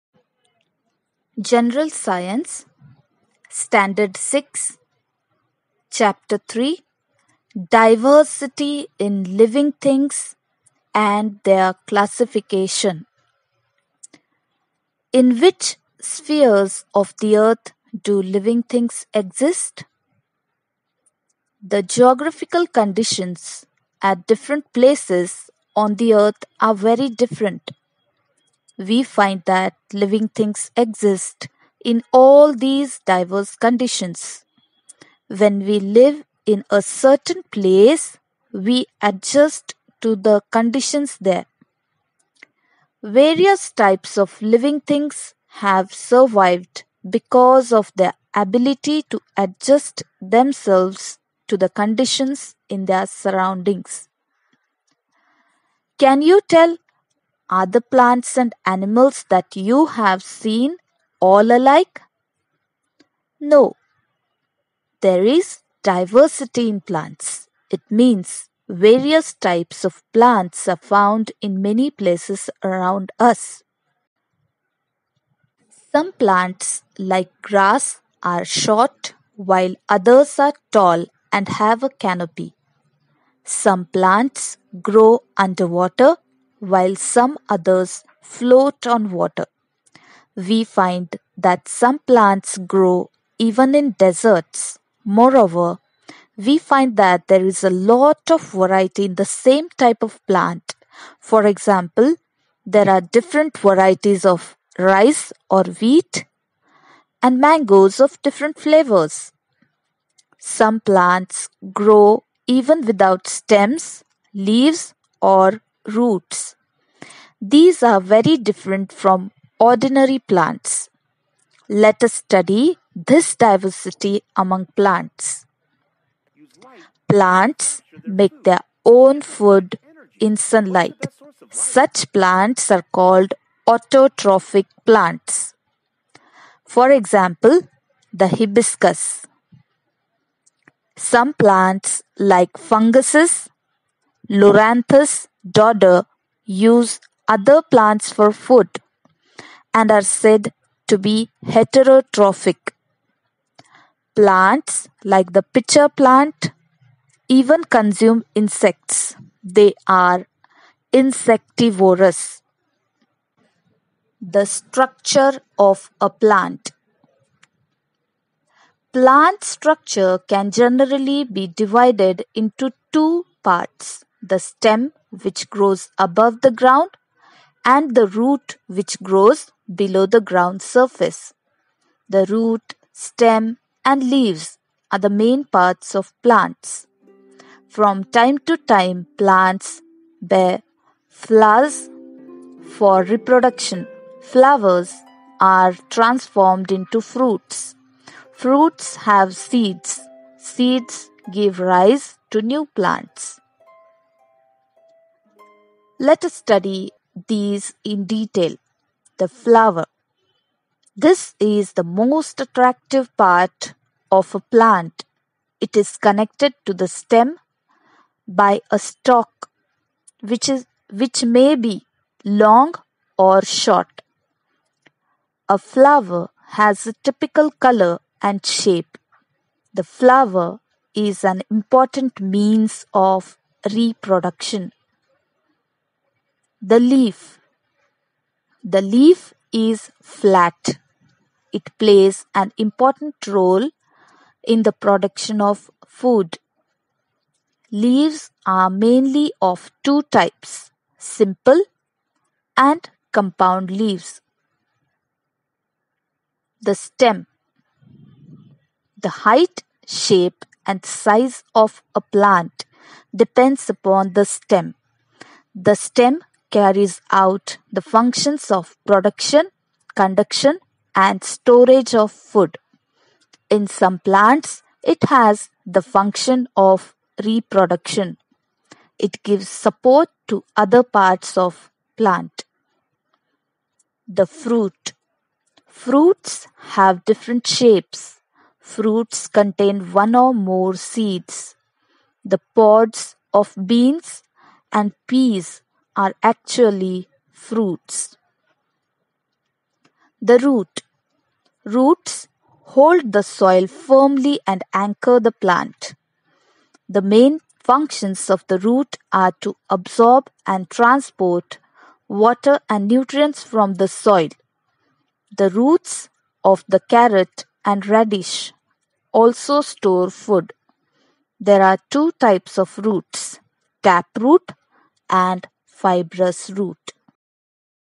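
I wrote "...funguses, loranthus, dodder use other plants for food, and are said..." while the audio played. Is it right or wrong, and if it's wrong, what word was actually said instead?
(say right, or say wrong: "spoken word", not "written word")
right.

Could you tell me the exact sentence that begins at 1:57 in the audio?
These are very different from ordinary plants.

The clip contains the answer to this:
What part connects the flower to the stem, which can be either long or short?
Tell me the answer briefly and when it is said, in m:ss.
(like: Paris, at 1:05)
A stalk, at 3:38.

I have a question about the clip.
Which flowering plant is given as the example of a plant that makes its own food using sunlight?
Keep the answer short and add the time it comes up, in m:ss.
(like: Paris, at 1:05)
Hibiscus, at 2:18.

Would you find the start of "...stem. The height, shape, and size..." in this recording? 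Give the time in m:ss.
4:16.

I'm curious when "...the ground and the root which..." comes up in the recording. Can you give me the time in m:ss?
2:56.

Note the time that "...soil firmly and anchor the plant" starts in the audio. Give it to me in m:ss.
5:03.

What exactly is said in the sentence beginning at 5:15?
The roots of the carrot and radish also store food.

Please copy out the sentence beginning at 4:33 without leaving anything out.
In some plants, it has the function of reproduction.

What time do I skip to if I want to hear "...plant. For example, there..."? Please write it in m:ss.
1:40.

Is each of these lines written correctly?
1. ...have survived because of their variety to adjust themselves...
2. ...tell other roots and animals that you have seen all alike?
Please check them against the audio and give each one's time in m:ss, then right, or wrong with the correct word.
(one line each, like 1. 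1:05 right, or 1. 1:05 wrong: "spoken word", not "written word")
1. 0:45 wrong: "ability", not "variety"
2. 0:56 wrong: "plants", not "roots".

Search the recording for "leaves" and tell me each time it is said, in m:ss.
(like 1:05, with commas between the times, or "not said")
1:54, 3:04, 4:07, 4:13.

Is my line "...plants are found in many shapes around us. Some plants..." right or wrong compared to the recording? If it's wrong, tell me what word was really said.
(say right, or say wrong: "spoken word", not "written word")
wrong: "places", not "shapes".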